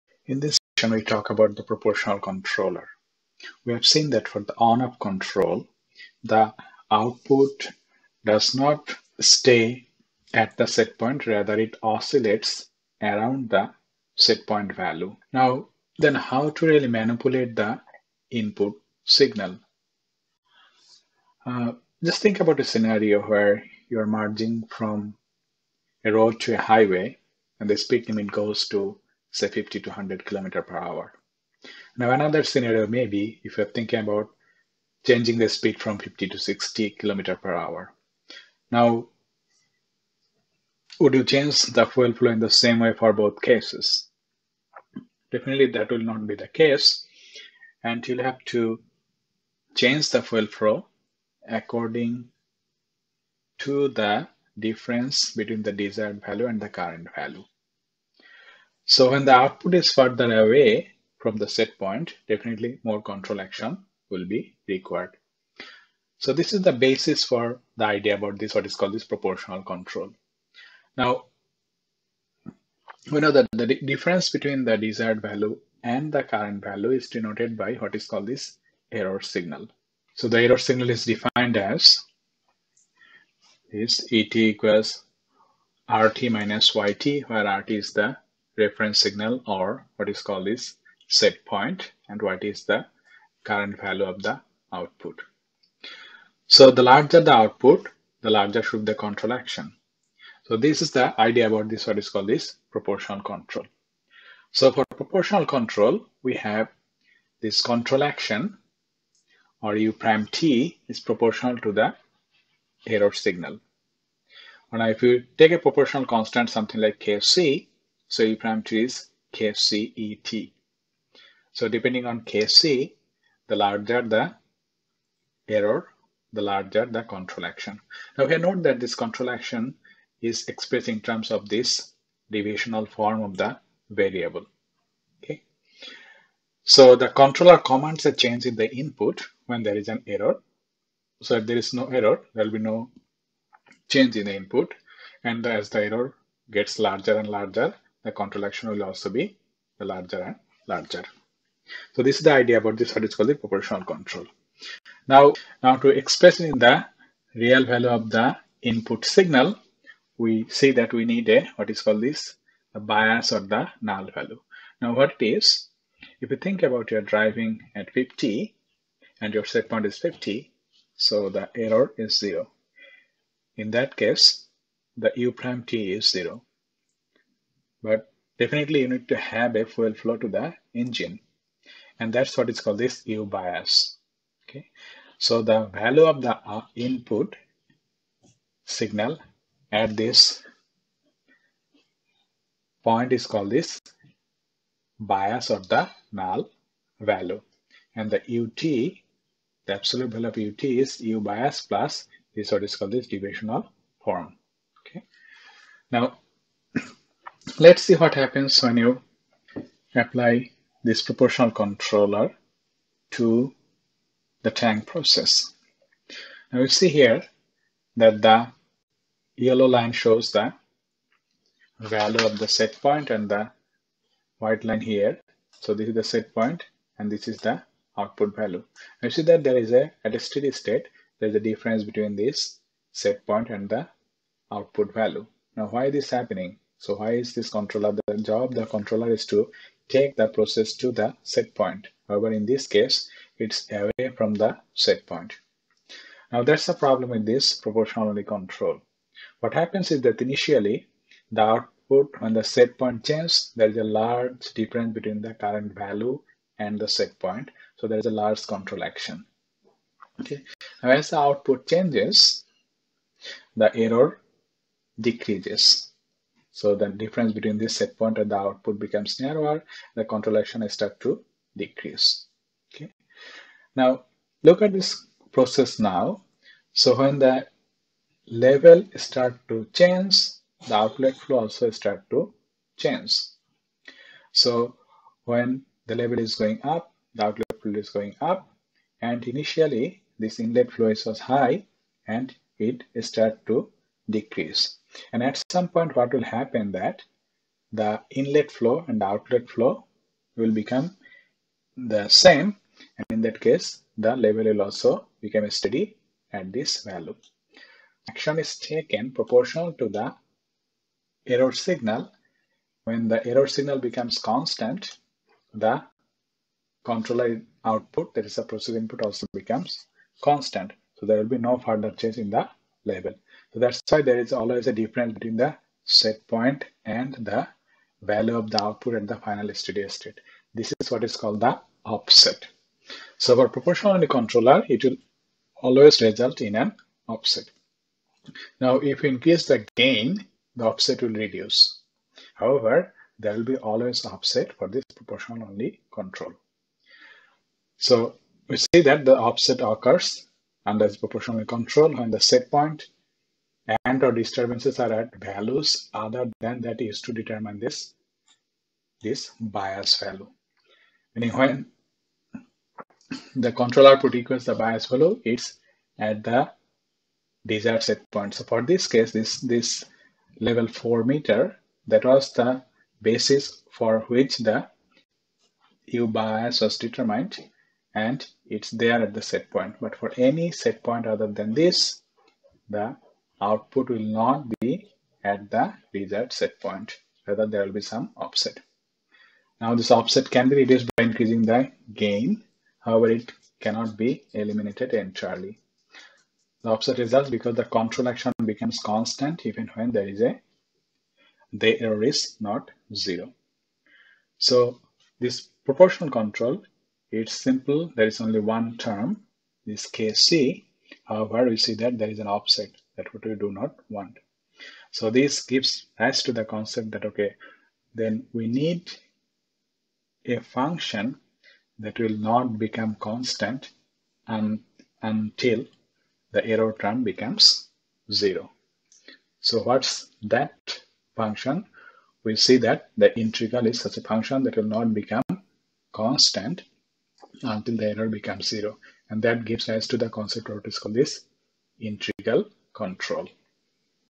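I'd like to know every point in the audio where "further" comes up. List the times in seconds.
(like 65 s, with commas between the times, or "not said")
59 s, 321 s.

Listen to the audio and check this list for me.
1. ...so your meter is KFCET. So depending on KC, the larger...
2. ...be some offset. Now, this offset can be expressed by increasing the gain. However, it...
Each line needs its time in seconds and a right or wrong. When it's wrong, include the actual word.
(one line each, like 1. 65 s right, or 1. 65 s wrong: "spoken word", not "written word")
1. 118 s wrong: "parameter", not "meter"
2. 387 s wrong: "reduced", not "expressed".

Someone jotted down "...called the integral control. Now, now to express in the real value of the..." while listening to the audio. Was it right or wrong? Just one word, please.
wrong.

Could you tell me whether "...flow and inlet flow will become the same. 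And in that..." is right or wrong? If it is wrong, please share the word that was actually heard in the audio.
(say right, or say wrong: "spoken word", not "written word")
wrong: "outlet", not "inlet".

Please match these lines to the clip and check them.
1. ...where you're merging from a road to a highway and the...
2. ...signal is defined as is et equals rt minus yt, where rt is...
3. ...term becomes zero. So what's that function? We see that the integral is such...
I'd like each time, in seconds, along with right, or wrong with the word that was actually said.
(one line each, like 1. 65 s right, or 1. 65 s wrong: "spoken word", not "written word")
1. 23 s right
2. 80 s right
3. 426 s right.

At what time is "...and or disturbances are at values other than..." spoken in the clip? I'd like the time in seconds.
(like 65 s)
353 s.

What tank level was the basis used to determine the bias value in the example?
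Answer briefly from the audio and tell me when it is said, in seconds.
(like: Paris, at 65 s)
4 meters, at 370 s.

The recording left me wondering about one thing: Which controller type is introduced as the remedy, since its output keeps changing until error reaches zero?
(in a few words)
integral control.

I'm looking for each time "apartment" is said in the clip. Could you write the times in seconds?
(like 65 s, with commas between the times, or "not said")
not said.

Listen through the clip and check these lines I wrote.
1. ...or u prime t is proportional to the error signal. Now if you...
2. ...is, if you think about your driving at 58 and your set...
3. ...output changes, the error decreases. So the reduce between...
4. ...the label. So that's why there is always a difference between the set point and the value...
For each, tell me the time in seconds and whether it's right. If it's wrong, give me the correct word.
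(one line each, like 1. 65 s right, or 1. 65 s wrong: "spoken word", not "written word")
1. 109 s right
2. 165 s wrong: "50", not "58"
3. 261 s wrong: "difference", not "reduce"
4. 322 s right.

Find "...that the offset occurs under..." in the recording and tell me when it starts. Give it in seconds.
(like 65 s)
348 s.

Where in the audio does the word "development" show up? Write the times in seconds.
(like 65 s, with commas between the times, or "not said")
not said.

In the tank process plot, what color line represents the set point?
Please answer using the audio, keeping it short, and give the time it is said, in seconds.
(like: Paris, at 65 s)
yellow, at 219 s.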